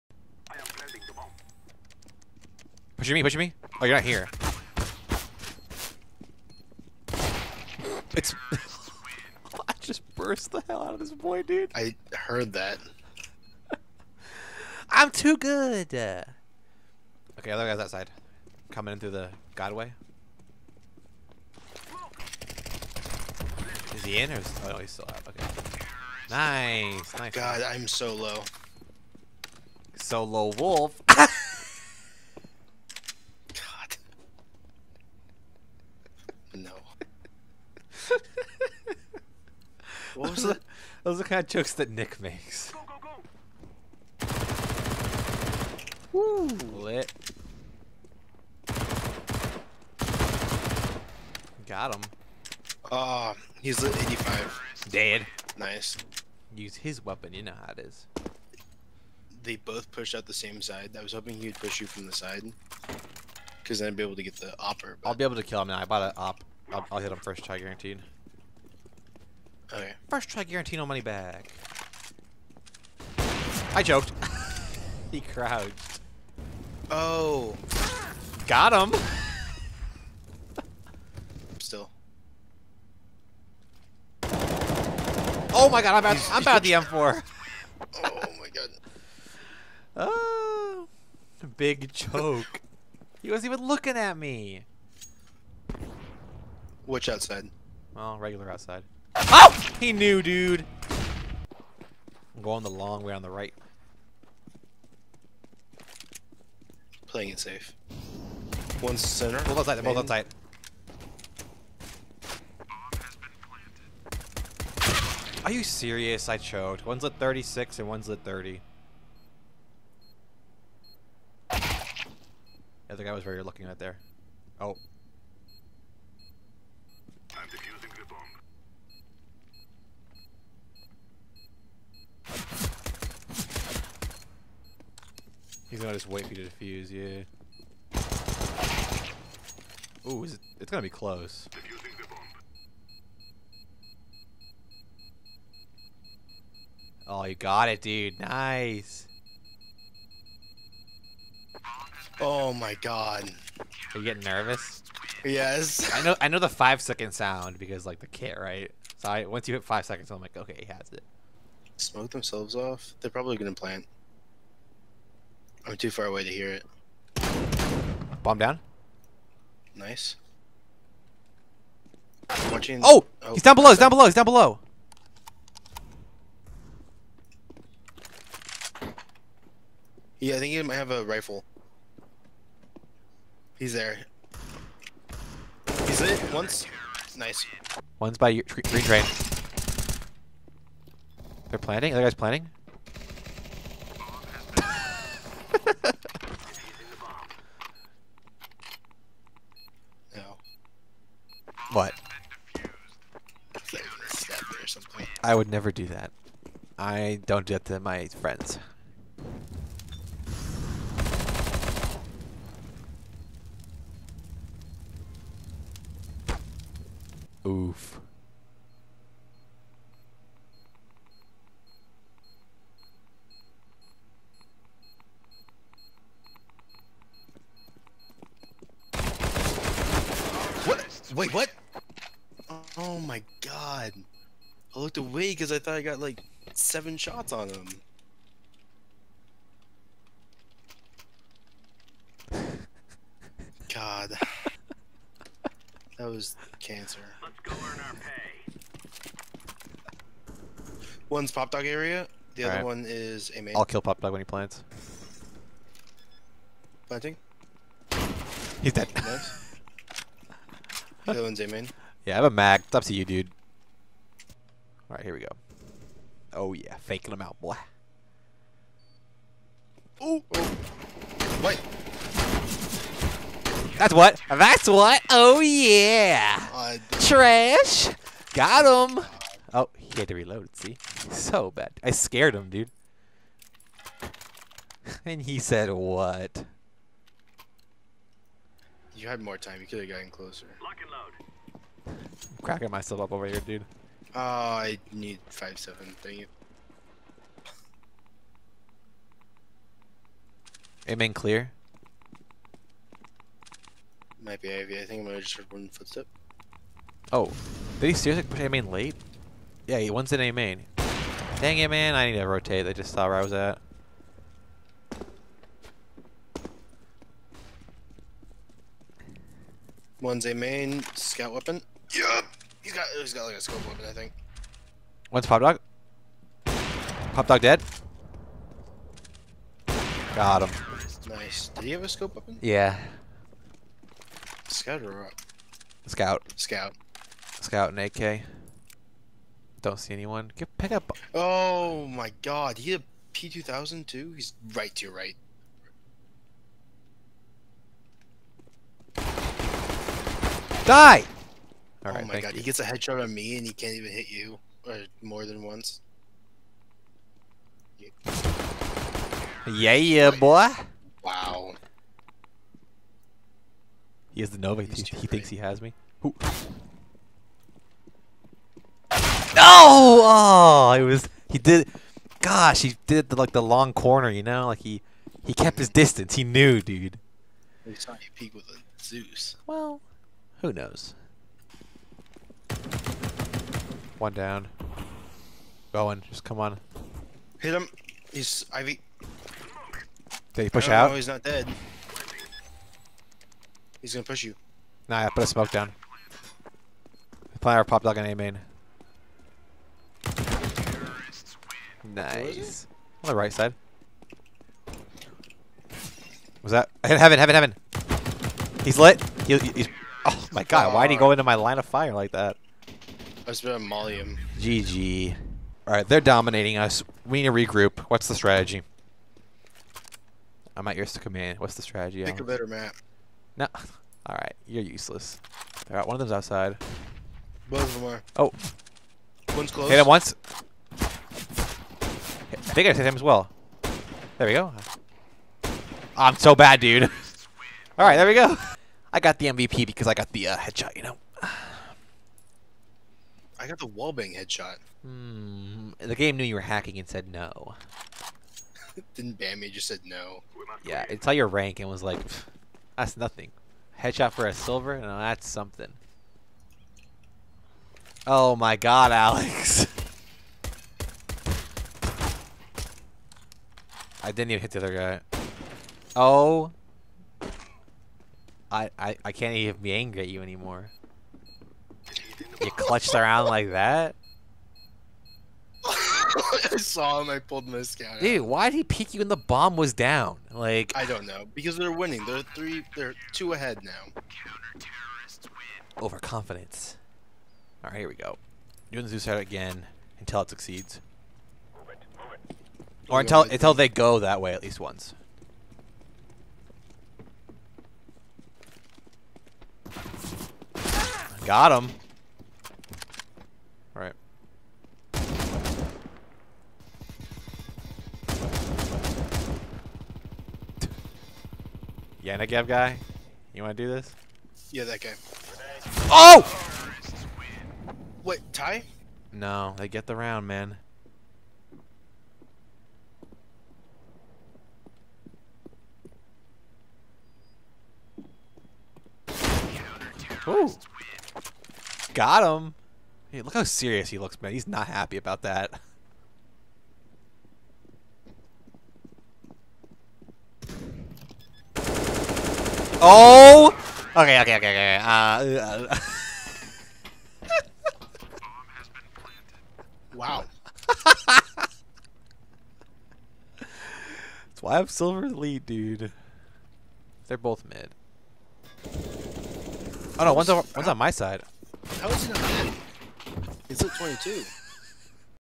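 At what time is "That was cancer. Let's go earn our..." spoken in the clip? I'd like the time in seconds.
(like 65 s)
246 s.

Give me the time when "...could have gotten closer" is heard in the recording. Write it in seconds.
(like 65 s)
289 s.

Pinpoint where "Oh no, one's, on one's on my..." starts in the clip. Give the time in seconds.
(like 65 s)
559 s.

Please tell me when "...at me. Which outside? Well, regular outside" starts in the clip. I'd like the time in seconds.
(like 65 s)
93 s.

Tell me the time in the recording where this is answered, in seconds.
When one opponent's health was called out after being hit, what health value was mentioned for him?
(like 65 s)
54 s.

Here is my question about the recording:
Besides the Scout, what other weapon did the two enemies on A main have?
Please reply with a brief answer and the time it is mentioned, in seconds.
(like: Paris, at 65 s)
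AK, at 337 s.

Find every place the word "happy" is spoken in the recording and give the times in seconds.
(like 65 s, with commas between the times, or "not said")
534 s.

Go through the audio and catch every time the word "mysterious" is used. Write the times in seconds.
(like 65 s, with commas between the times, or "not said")
not said.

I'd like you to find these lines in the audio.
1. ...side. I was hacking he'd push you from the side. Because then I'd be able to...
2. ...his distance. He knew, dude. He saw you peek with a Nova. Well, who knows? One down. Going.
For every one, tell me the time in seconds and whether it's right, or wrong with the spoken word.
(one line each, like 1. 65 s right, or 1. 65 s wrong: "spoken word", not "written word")
1. 60 s wrong: "hoping", not "hacking"
2. 375 s wrong: "Zeus", not "Nova".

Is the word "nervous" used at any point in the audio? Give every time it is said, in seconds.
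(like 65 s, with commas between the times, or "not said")
154 s.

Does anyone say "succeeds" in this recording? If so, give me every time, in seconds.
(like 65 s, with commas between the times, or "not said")
490 s.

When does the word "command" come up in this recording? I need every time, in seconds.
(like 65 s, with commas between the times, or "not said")
420 s.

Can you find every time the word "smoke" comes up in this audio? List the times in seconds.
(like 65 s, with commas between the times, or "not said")
161 s, 395 s.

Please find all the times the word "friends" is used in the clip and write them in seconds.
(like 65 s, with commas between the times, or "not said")
208 s.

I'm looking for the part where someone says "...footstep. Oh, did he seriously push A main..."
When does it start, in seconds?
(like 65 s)
305 s.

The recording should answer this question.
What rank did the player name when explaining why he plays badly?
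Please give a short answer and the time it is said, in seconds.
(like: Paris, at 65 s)
Silver Elite, at 554 s.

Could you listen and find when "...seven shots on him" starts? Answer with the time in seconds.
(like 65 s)
236 s.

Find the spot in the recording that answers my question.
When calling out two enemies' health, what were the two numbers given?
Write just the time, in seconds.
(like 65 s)
116 s.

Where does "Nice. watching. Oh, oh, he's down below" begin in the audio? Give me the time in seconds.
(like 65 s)
169 s.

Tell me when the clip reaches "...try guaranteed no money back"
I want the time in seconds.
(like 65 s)
70 s.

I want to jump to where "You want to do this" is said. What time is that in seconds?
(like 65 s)
513 s.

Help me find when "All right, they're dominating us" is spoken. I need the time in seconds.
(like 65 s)
415 s.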